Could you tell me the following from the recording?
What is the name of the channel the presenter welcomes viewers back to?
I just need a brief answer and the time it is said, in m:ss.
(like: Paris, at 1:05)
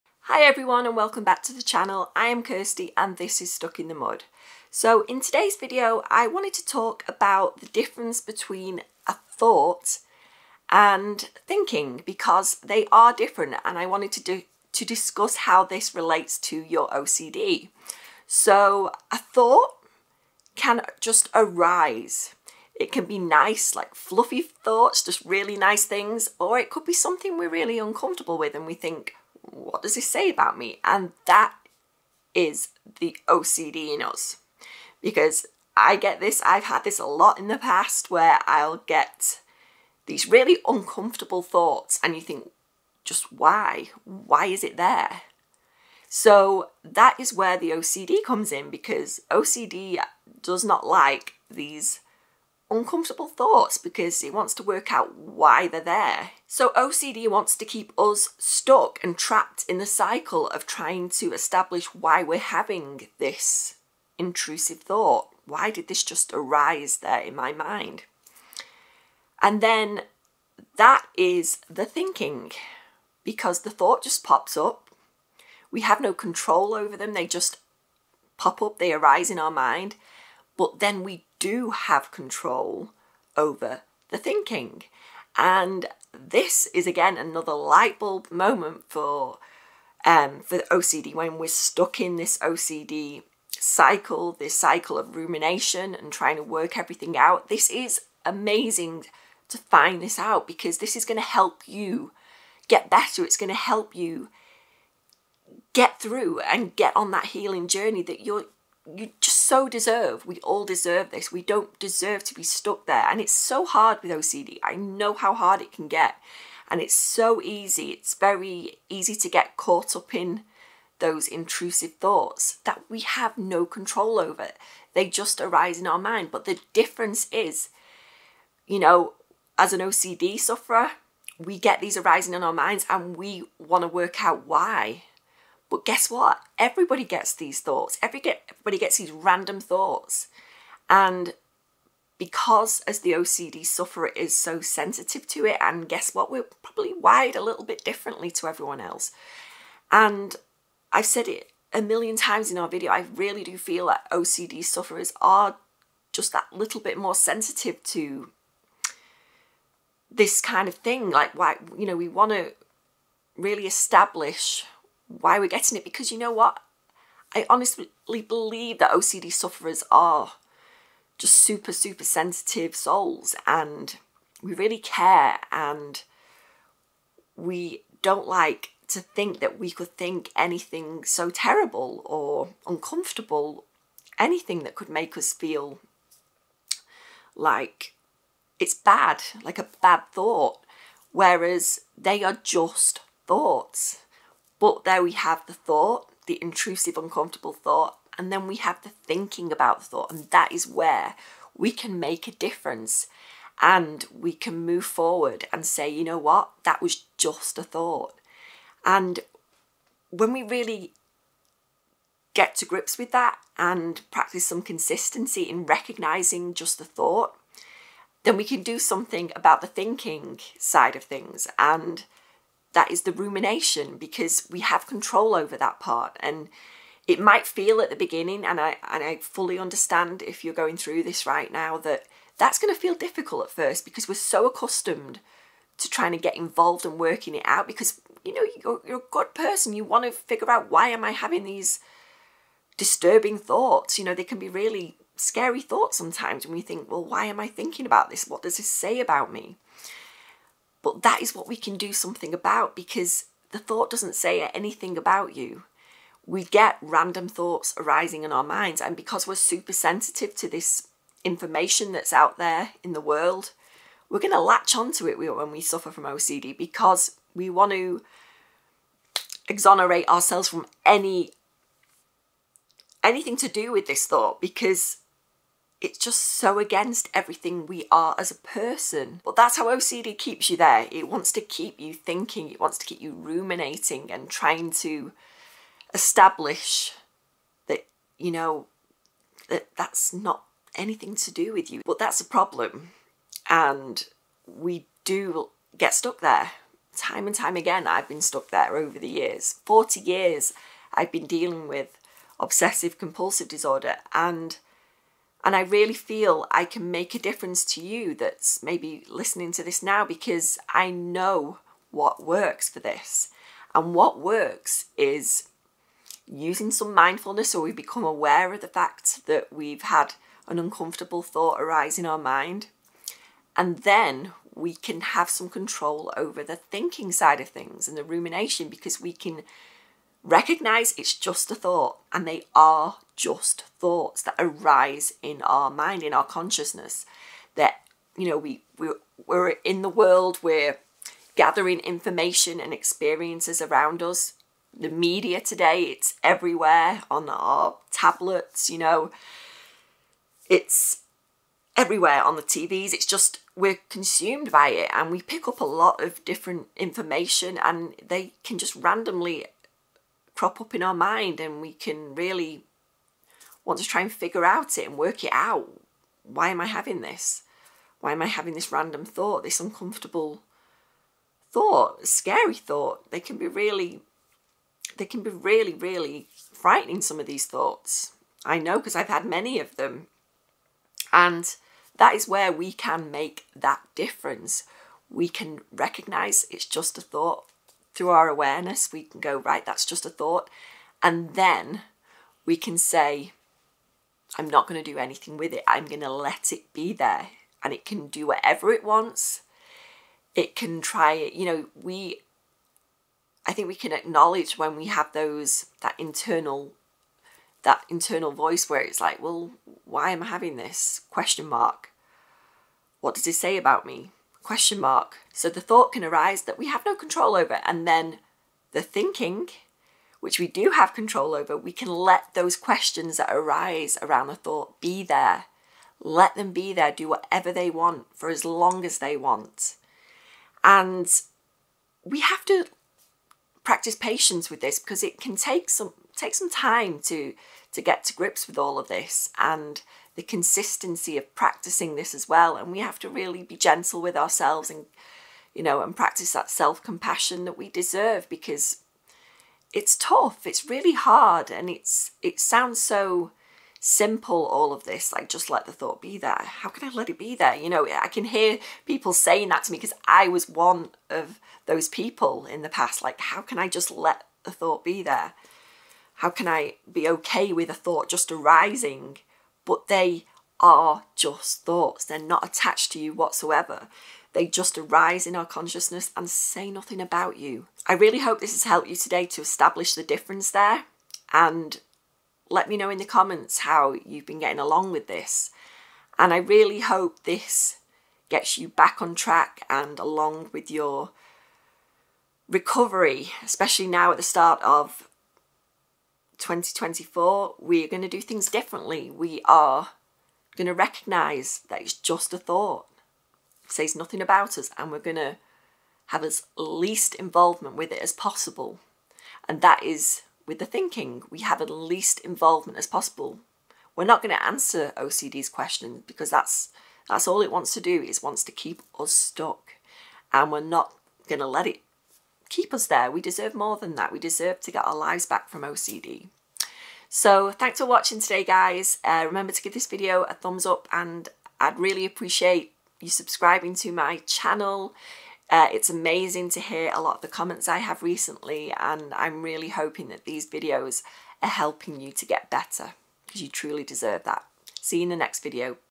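Stuck in the Mud, at 0:03.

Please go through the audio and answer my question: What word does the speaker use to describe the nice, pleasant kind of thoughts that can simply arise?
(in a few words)
fluffy.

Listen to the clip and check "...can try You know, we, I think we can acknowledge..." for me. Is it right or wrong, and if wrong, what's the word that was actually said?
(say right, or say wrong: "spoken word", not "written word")
right.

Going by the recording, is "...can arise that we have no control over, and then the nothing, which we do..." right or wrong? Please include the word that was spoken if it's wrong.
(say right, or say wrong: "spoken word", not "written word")
wrong: "thinking", not "nothing".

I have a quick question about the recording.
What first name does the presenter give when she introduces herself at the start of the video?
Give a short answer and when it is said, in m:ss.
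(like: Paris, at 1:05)
Kirsty, at 0:02.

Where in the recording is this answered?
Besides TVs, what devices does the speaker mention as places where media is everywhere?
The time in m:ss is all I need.
5:47.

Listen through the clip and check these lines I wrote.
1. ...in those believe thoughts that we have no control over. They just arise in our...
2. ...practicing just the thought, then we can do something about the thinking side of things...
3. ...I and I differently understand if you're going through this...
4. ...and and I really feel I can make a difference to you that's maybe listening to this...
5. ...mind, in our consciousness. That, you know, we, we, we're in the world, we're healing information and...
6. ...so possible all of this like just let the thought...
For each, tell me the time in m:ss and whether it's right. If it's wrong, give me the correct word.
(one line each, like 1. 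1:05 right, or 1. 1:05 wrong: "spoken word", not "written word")
1. 2:00 wrong: "intrusive", not "believe"
2. 3:35 wrong: "recognizing", not "practicing"
3. 3:48 wrong: "fully", not "differently"
4. 5:04 right
5. 5:35 wrong: "gathering", not "healing"
6. 7:32 wrong: "simple", not "possible".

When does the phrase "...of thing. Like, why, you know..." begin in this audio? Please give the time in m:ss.
2:40.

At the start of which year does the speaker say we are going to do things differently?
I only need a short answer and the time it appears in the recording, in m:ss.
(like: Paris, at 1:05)
2024, at 8:16.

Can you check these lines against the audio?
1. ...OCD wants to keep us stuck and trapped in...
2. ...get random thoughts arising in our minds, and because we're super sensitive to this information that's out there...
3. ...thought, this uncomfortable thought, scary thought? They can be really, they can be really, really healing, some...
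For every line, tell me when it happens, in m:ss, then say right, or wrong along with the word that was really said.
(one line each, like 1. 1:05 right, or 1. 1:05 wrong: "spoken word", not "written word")
1. 0:56 right
2. 4:16 right
3. 6:09 wrong: "frightening", not "healing".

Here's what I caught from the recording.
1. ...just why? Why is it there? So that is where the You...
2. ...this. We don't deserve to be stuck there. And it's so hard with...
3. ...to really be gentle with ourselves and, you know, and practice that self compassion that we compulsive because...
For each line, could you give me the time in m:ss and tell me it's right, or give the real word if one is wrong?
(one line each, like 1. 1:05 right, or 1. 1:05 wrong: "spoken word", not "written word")
1. 0:43 wrong: "OCD", not "You"
2. 1:51 right
3. 7:22 wrong: "deserve", not "compulsive".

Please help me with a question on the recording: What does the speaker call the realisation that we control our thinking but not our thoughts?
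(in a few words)
light bulb moment.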